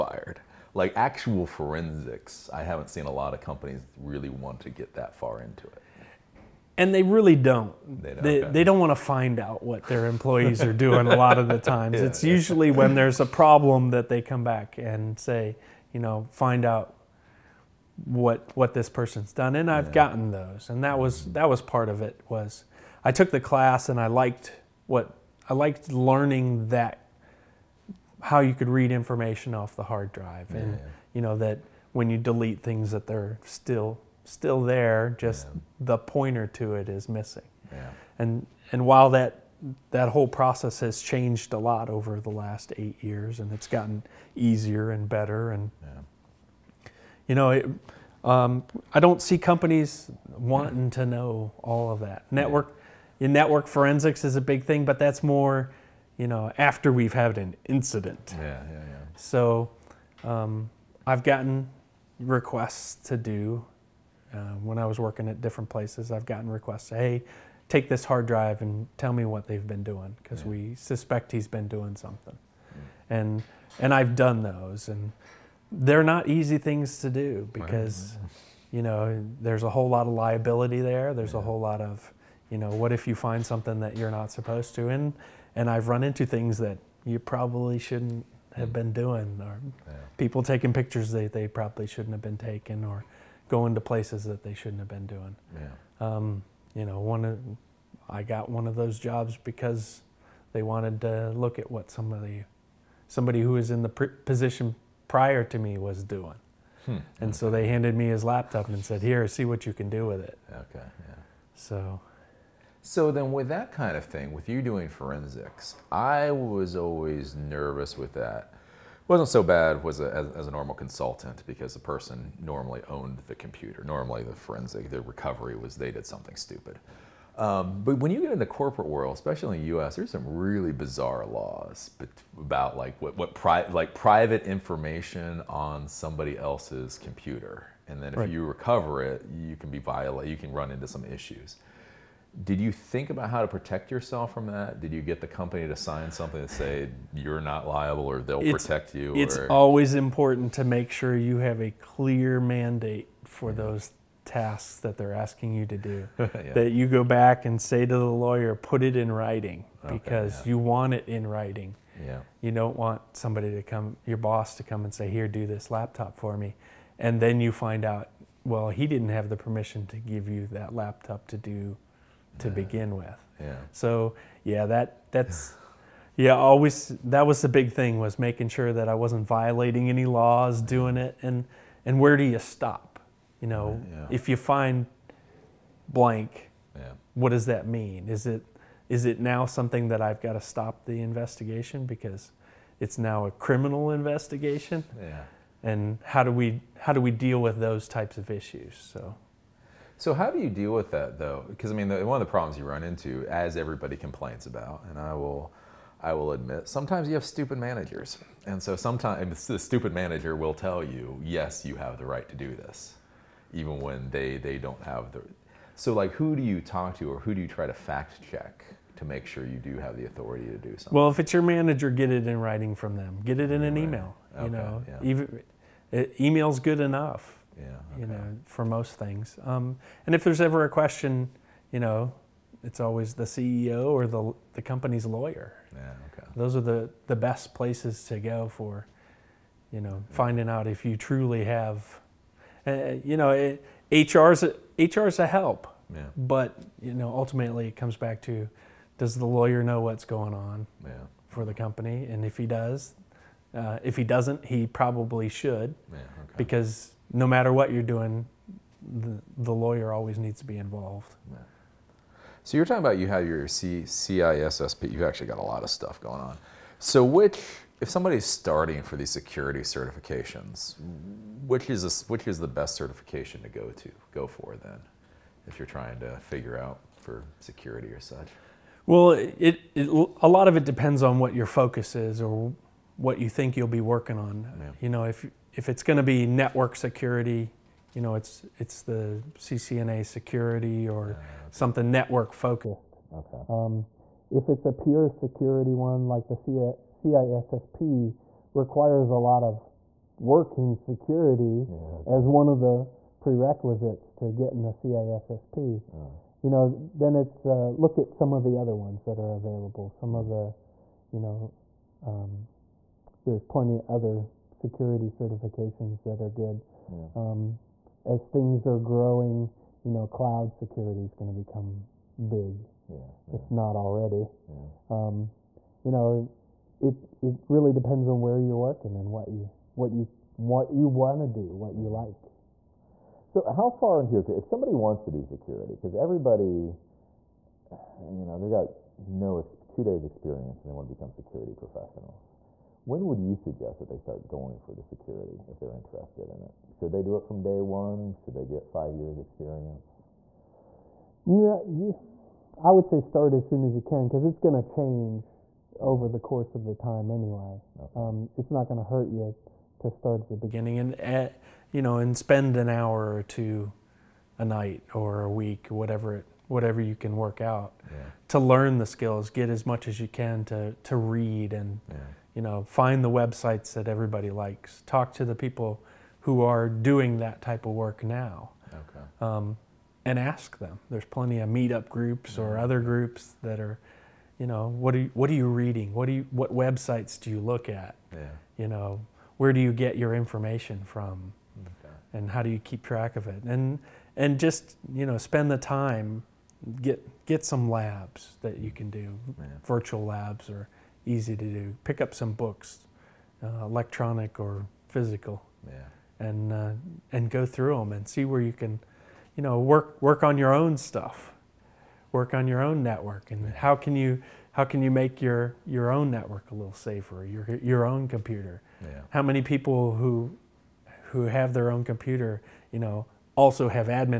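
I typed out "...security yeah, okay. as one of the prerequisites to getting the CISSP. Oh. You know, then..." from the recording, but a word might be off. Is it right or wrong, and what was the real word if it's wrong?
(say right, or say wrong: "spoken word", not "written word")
right.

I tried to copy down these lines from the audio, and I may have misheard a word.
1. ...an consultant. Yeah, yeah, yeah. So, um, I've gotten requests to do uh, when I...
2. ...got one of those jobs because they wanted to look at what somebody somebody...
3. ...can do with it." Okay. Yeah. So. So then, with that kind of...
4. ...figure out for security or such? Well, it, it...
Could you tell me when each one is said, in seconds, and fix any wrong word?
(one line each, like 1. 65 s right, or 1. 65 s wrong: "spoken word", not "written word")
1. 57 s wrong: "incident", not "consultant"
2. 98 s right
3. 109 s right
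4. 276 s right.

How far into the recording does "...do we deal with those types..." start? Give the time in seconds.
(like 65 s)
196 s.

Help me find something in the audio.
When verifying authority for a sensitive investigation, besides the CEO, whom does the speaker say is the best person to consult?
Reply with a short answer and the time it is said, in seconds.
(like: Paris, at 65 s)
The company's lawyer, at 234 s.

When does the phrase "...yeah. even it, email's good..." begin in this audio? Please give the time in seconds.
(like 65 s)
224 s.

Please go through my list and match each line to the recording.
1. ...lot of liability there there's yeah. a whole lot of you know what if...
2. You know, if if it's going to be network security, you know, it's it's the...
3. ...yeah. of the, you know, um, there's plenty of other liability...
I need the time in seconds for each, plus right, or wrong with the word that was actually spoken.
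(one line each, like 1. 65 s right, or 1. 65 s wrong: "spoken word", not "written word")
1. 79 s right
2. 284 s right
3. 310 s wrong: "security", not "liability".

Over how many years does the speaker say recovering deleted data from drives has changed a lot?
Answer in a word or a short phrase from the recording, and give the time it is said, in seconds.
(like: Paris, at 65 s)
8 years, at 42 s.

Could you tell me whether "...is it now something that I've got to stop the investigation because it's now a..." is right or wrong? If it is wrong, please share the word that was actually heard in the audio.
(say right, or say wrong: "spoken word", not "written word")
right.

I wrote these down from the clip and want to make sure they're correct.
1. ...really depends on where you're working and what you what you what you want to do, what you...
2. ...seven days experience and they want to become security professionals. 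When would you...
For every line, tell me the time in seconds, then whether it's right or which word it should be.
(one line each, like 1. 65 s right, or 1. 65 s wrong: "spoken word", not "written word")
1. 327 s right
2. 339 s wrong: "two", not "seven".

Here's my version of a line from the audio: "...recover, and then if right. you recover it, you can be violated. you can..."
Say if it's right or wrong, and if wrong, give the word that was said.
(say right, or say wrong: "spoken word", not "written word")
wrong: "computer", not "recover".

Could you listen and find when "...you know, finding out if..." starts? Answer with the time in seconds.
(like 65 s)
239 s.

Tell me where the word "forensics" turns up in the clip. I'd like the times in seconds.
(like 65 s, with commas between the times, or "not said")
1 s, 53 s, 114 s, 124 s.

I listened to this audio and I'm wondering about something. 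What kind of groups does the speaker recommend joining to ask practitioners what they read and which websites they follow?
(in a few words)
Meetup groups.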